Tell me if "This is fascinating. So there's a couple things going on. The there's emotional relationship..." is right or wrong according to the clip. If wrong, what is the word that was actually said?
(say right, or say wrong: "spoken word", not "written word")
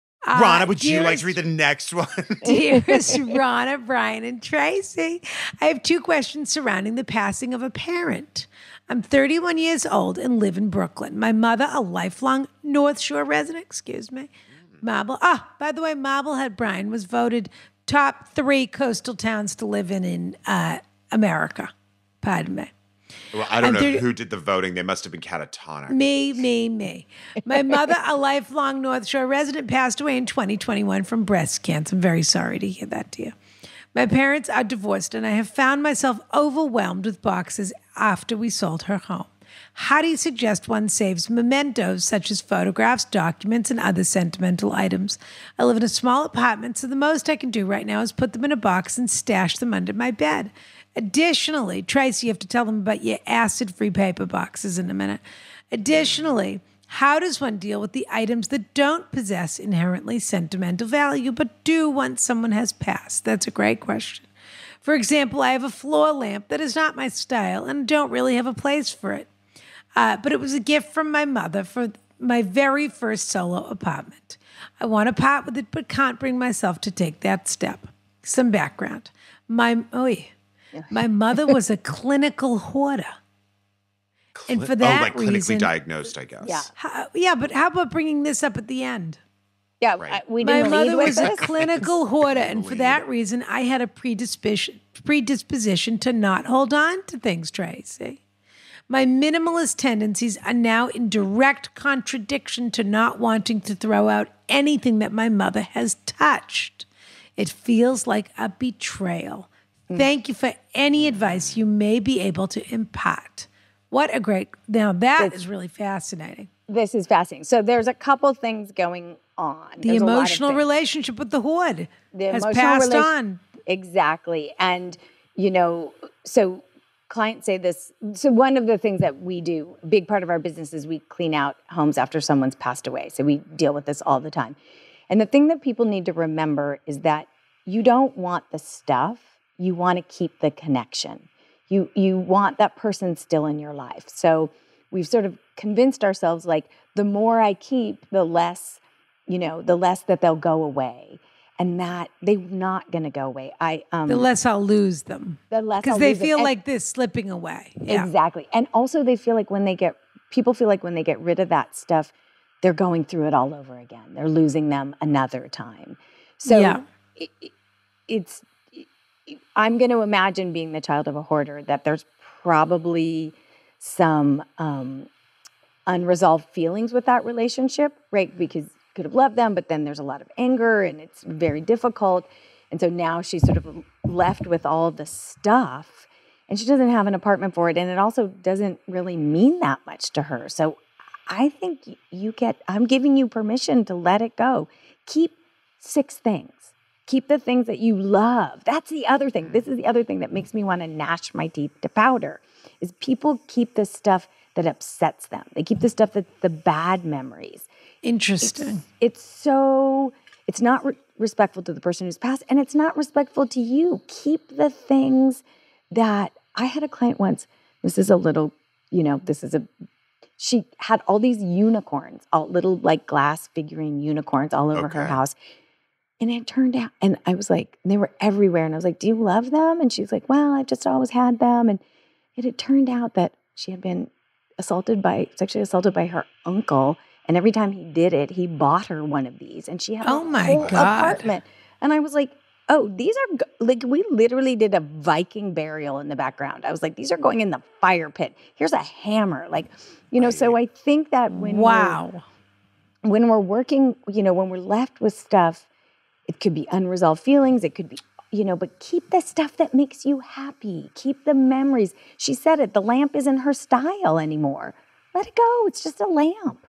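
right.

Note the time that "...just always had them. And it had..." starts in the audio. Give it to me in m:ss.
3:50.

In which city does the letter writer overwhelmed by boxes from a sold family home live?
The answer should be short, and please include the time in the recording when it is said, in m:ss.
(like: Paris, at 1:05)
Brooklyn, at 0:10.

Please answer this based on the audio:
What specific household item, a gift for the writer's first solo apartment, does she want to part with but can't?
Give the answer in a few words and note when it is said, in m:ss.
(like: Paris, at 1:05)
Floor lamp, at 1:05.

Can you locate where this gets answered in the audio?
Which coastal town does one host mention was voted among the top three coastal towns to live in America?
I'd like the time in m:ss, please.
0:15.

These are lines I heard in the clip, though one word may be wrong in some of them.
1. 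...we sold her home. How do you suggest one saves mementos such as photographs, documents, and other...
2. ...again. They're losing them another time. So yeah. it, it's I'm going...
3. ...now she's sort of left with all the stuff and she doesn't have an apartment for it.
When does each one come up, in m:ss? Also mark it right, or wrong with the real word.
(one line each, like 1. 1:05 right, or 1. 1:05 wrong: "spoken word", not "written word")
1. 0:38 right
2. 2:43 right
3. 3:02 right.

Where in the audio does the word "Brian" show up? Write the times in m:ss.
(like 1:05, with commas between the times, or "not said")
0:03, 0:16.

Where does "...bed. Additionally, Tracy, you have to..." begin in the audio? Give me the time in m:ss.
0:50.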